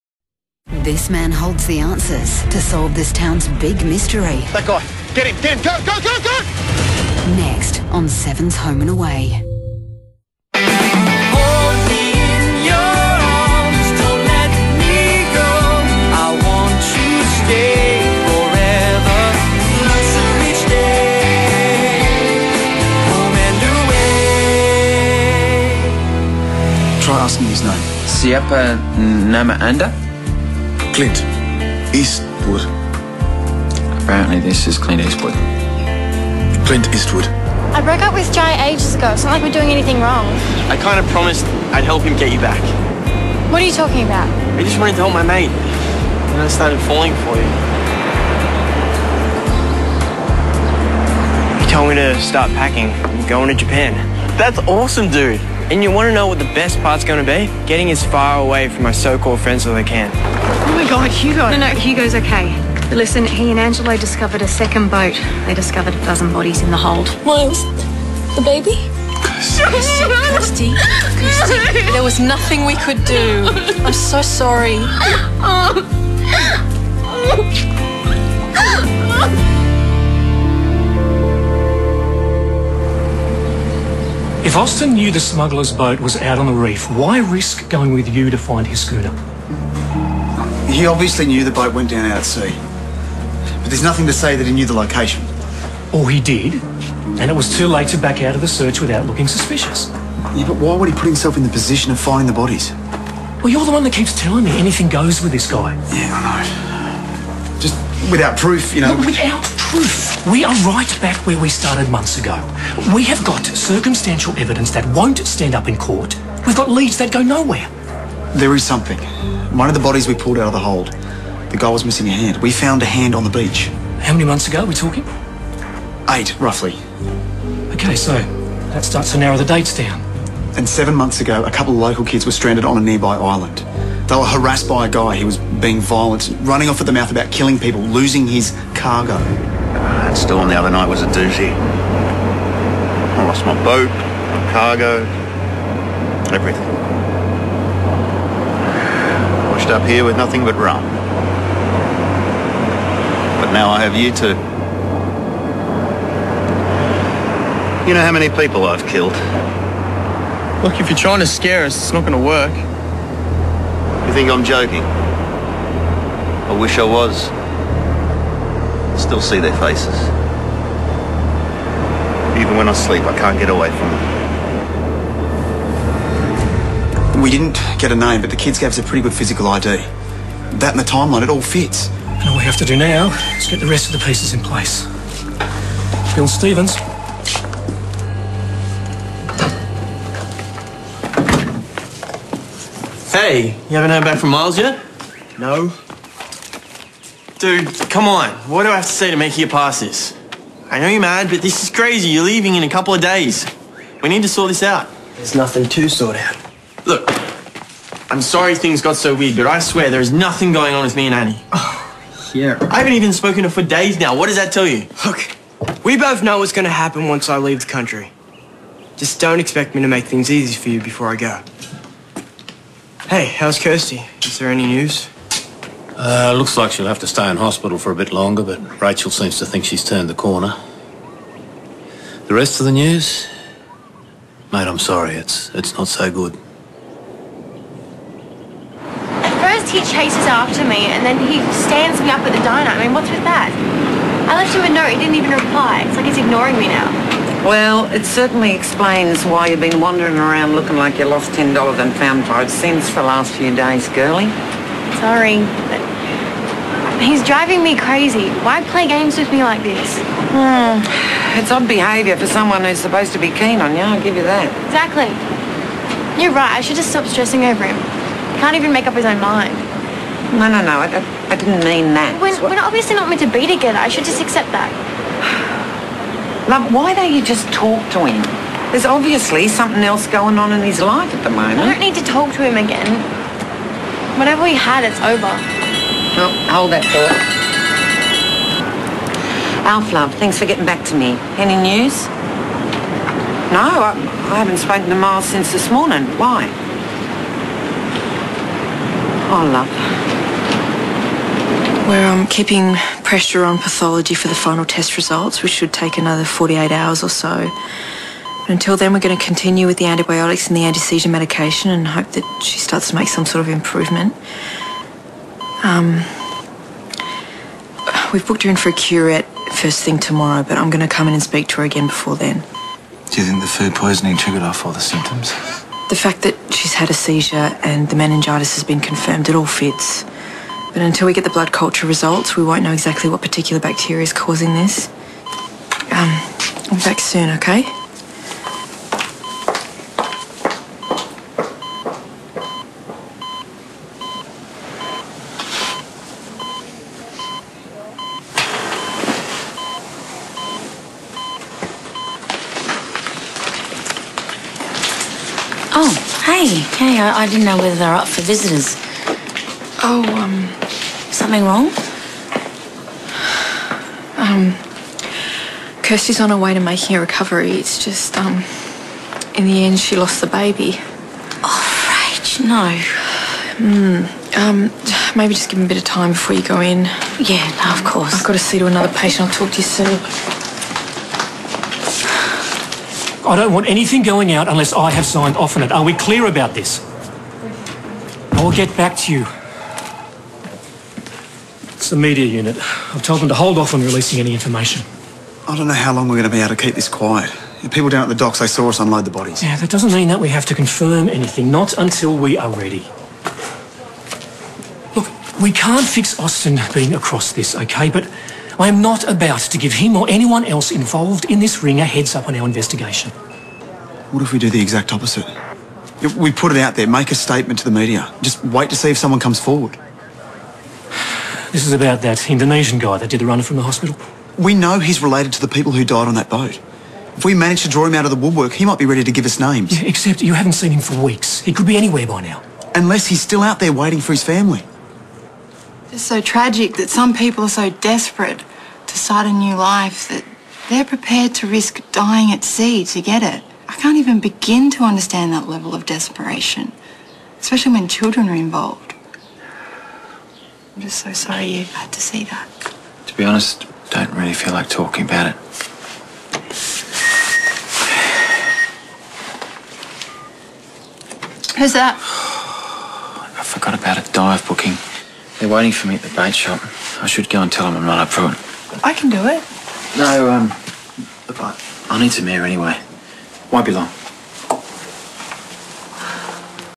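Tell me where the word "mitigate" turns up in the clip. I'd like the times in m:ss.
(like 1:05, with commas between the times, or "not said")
not said.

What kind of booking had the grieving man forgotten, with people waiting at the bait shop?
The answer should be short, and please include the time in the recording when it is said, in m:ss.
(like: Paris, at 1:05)
dive booking, at 7:44.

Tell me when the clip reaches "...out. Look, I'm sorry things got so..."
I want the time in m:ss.
3:26.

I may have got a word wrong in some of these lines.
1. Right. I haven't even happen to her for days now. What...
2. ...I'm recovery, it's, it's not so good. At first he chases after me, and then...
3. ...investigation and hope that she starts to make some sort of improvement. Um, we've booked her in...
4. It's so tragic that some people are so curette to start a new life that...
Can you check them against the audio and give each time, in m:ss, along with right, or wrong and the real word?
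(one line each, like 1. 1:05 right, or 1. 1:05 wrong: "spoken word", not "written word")
1. 3:32 wrong: "spoken", not "happen"
2. 3:54 wrong: "sorry", not "recovery"
3. 5:11 wrong: "medication", not "investigation"
4. 7:15 wrong: "desperate", not "curette".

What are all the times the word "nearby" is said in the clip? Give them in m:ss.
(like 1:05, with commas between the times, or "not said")
2:12.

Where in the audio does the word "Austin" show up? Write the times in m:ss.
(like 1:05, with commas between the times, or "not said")
1:24, 6:46.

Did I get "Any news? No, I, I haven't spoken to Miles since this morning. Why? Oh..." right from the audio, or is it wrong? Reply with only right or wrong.
right.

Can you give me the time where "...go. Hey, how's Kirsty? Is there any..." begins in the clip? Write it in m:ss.
3:41.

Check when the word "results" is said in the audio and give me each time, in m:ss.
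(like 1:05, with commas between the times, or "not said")
5:04, 5:31.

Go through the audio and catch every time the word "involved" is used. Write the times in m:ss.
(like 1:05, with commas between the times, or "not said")
6:50, 7:28.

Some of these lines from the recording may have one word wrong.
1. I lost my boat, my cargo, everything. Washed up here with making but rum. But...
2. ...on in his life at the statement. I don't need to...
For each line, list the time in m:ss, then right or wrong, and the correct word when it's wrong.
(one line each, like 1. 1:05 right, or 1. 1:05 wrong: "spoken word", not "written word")
1. 2:21 wrong: "nothing", not "making"
2. 4:40 wrong: "moment", not "statement".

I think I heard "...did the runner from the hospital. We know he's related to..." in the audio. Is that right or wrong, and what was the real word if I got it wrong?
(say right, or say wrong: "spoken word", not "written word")
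right.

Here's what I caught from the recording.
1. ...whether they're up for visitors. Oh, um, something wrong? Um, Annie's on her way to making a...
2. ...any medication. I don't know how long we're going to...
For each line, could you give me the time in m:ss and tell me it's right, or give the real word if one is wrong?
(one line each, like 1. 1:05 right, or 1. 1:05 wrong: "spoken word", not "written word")
1. 5:57 wrong: "Kirsty", not "Annie"
2. 6:34 wrong: "information", not "medication".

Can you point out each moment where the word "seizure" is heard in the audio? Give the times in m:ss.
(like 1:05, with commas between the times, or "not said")
5:10, 5:26.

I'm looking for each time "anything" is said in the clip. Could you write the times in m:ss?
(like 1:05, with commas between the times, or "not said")
0:39, 1:44, 6:23, 6:41.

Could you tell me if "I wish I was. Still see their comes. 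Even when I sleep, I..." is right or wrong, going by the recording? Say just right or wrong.
wrong.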